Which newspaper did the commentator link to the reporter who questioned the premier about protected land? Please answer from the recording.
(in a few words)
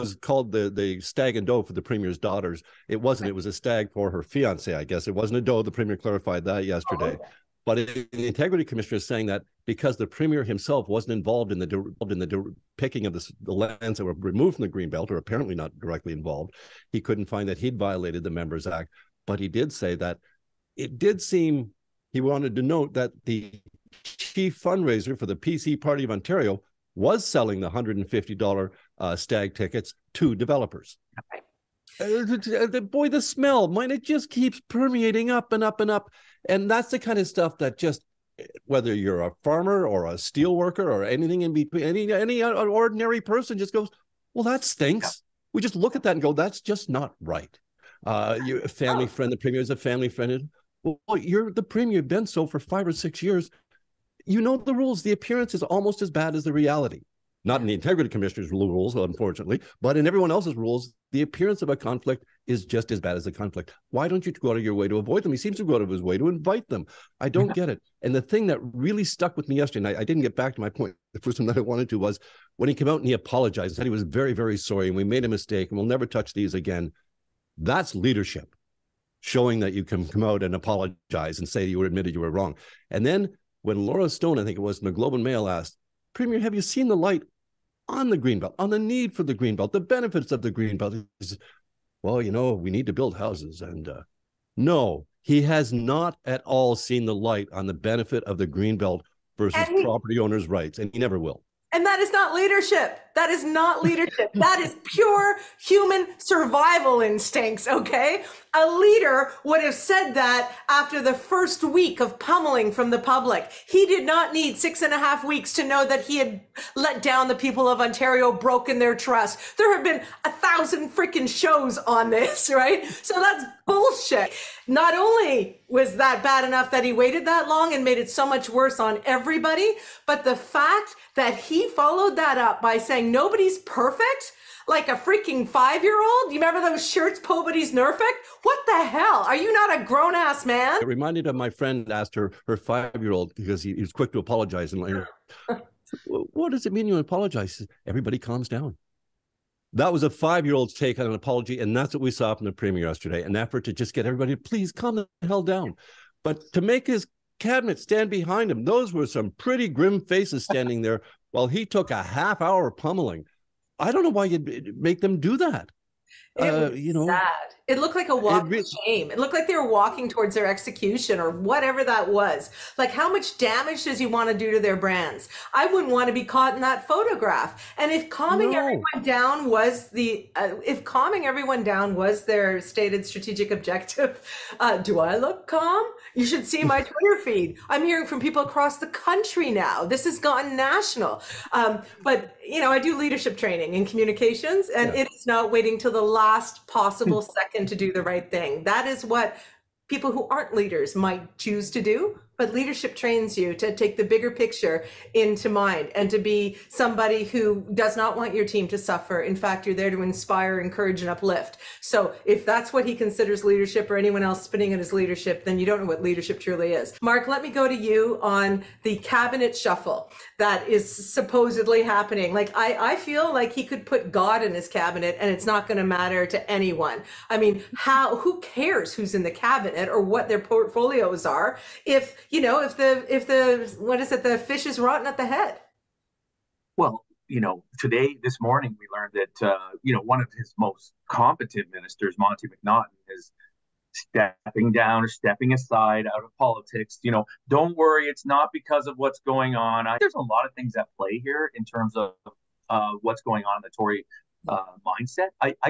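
Globe and Mail.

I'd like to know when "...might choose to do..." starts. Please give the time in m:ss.
3:20.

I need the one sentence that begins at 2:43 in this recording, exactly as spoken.
I don't know why you'd make them do that.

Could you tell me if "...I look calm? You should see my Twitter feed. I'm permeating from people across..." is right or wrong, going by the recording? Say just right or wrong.
wrong.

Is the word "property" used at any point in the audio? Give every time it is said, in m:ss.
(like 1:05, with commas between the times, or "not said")
1:39.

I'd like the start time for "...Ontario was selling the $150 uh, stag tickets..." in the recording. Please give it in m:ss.
0:26.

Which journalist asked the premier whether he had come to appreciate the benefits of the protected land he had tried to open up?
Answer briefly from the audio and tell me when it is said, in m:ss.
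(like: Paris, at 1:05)
Laura Stone, at 1:23.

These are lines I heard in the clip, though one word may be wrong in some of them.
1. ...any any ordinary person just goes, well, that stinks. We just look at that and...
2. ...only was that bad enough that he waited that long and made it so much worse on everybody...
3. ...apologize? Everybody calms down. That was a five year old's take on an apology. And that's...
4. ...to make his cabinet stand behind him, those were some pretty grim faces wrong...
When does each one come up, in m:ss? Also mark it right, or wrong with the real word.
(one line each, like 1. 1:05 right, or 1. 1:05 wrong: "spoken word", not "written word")
1. 0:41 right
2. 2:04 right
3. 2:26 right
4. 2:36 wrong: "standing", not "wrong".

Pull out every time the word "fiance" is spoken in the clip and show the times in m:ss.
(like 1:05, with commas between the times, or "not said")
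0:04.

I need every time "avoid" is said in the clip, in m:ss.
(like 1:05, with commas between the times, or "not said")
1:04.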